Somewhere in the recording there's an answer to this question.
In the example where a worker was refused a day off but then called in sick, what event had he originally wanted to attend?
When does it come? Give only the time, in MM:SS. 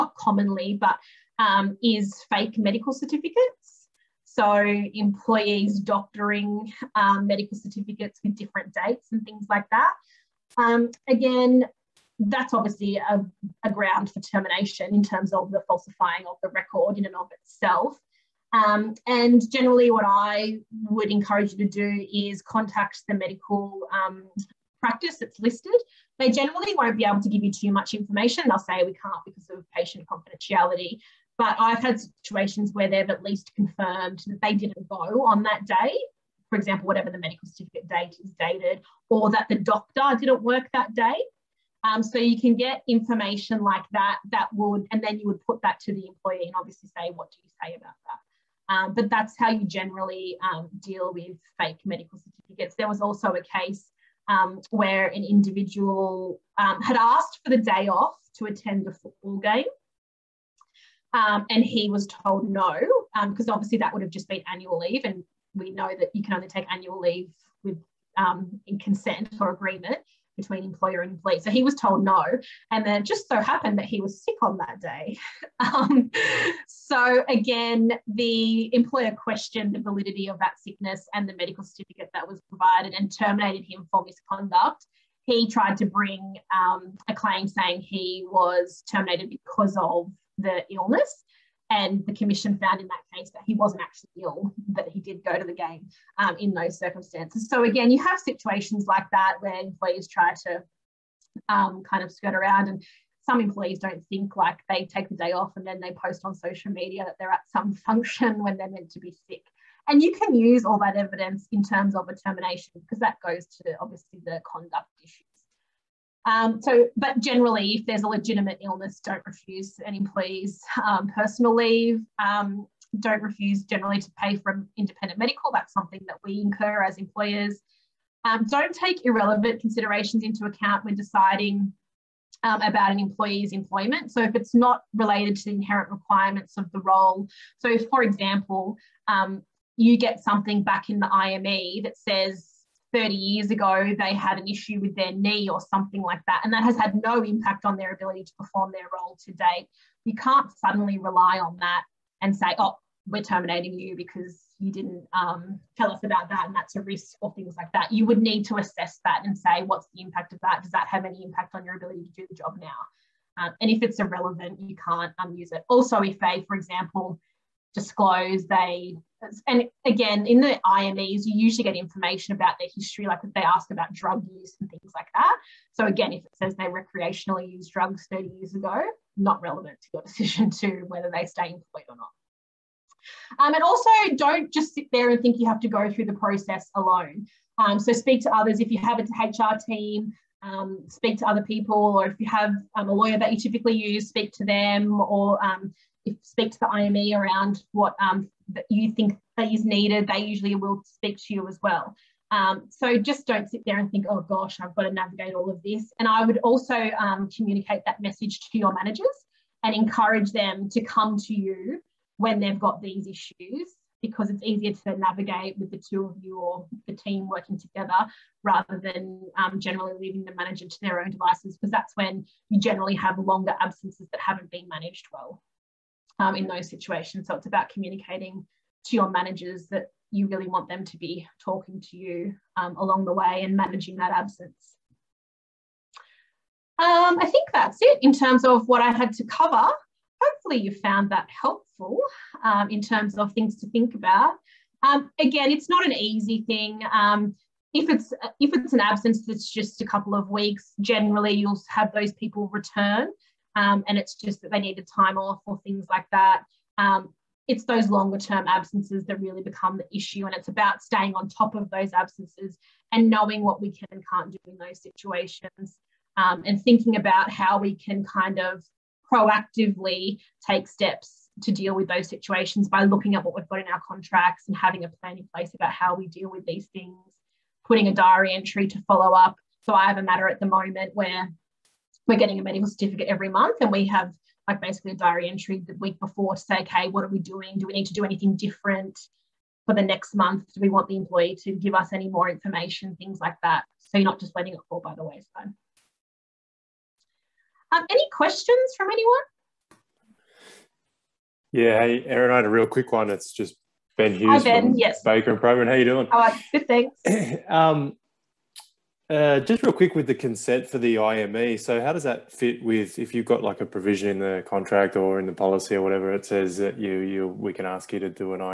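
00:58.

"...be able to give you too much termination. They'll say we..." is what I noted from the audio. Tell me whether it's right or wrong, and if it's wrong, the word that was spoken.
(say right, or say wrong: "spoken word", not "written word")
wrong: "information", not "termination".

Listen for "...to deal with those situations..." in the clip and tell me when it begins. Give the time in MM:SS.
04:31.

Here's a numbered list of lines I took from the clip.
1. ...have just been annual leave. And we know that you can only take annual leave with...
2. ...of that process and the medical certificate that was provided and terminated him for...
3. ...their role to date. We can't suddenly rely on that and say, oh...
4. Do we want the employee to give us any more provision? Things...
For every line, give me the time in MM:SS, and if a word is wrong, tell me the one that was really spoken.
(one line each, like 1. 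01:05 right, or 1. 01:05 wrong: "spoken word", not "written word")
1. 01:04 right
2. 01:20 wrong: "sickness", not "process"
3. 02:28 right
4. 04:50 wrong: "information", not "provision".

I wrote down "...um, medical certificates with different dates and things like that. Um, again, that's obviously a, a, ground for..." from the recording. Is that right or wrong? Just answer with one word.
right.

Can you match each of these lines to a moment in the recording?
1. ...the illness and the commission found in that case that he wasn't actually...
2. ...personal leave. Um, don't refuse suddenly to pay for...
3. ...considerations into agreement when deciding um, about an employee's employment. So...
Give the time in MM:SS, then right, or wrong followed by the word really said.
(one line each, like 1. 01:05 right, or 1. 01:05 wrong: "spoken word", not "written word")
1. 01:30 right
2. 02:01 wrong: "generally", not "suddenly"
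3. 02:09 wrong: "account", not "agreement".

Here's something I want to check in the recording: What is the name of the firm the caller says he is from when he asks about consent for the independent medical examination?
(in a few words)
Baker and Proven.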